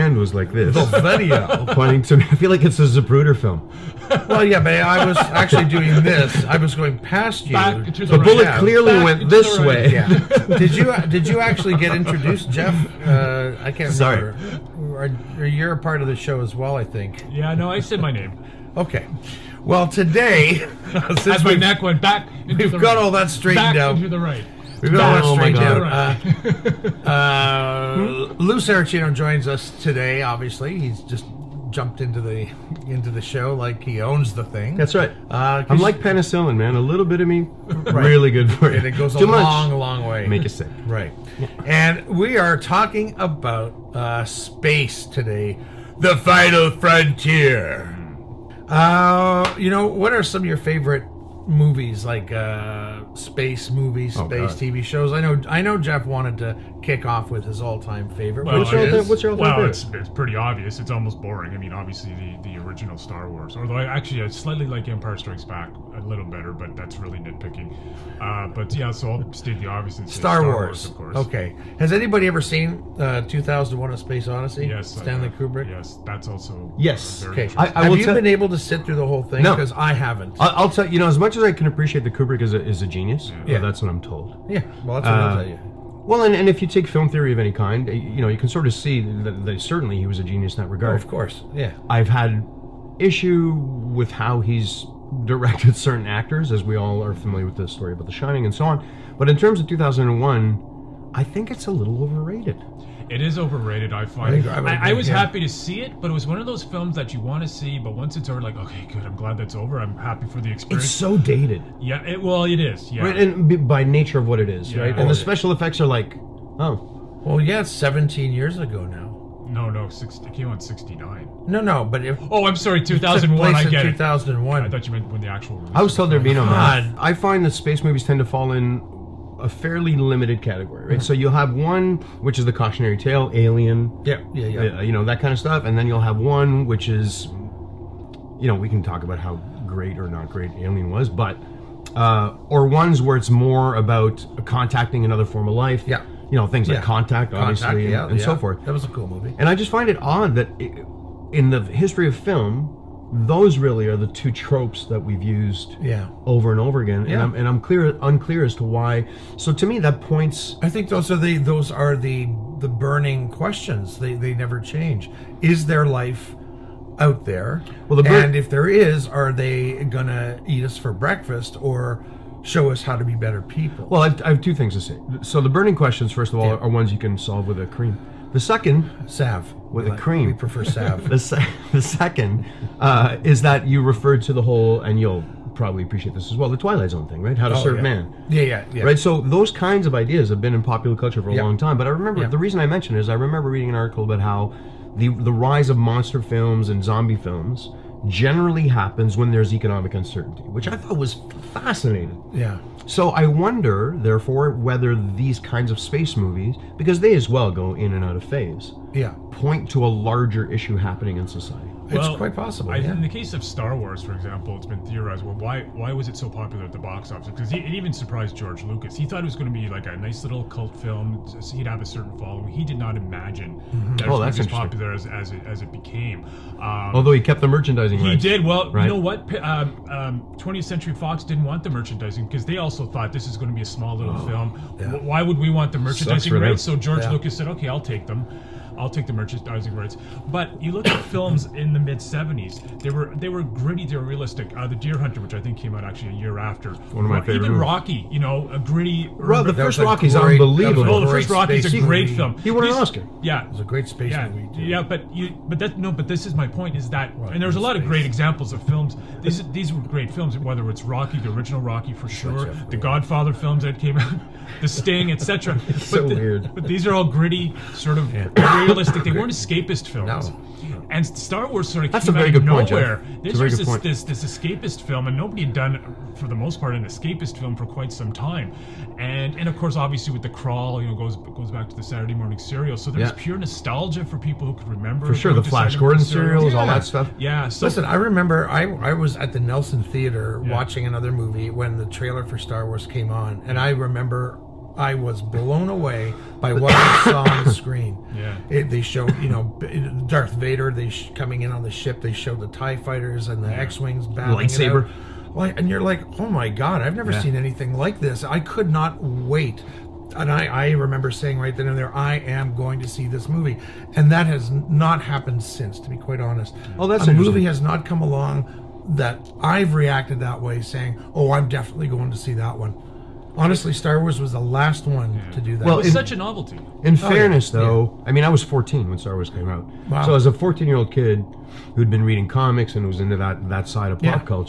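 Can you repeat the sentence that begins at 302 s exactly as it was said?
They showed the Tie fighters and the yeah.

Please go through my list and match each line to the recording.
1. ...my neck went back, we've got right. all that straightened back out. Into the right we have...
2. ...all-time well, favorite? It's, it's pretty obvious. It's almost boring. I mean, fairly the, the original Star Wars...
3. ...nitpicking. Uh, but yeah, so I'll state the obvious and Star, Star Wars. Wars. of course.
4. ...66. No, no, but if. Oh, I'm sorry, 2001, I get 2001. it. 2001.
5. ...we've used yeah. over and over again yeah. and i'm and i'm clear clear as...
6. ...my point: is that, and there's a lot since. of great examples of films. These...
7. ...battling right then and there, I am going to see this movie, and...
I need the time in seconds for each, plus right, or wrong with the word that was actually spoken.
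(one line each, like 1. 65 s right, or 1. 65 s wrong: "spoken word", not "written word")
1. 21 s right
2. 59 s wrong: "obviously", not "fairly"
3. 67 s right
4. 120 s wrong: "69", not "66"
5. 154 s wrong: "unclear", not "clear"
6. 256 s wrong: "space", not "since"
7. 311 s wrong: "saying", not "battling".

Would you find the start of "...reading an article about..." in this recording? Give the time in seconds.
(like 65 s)
193 s.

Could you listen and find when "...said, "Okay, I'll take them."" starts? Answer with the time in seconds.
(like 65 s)
237 s.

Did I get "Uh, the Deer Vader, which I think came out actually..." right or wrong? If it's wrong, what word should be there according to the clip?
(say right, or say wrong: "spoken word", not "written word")
wrong: "Hunter", not "Vader".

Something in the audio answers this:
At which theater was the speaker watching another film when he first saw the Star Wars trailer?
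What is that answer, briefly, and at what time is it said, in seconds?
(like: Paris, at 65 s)
Nelson Theater, at 289 s.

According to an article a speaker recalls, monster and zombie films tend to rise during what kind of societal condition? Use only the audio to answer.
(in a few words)
economic uncertainty.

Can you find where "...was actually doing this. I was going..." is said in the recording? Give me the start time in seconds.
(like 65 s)
5 s.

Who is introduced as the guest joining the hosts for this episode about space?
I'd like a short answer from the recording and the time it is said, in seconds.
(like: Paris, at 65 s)
Lou Saracino, at 28 s.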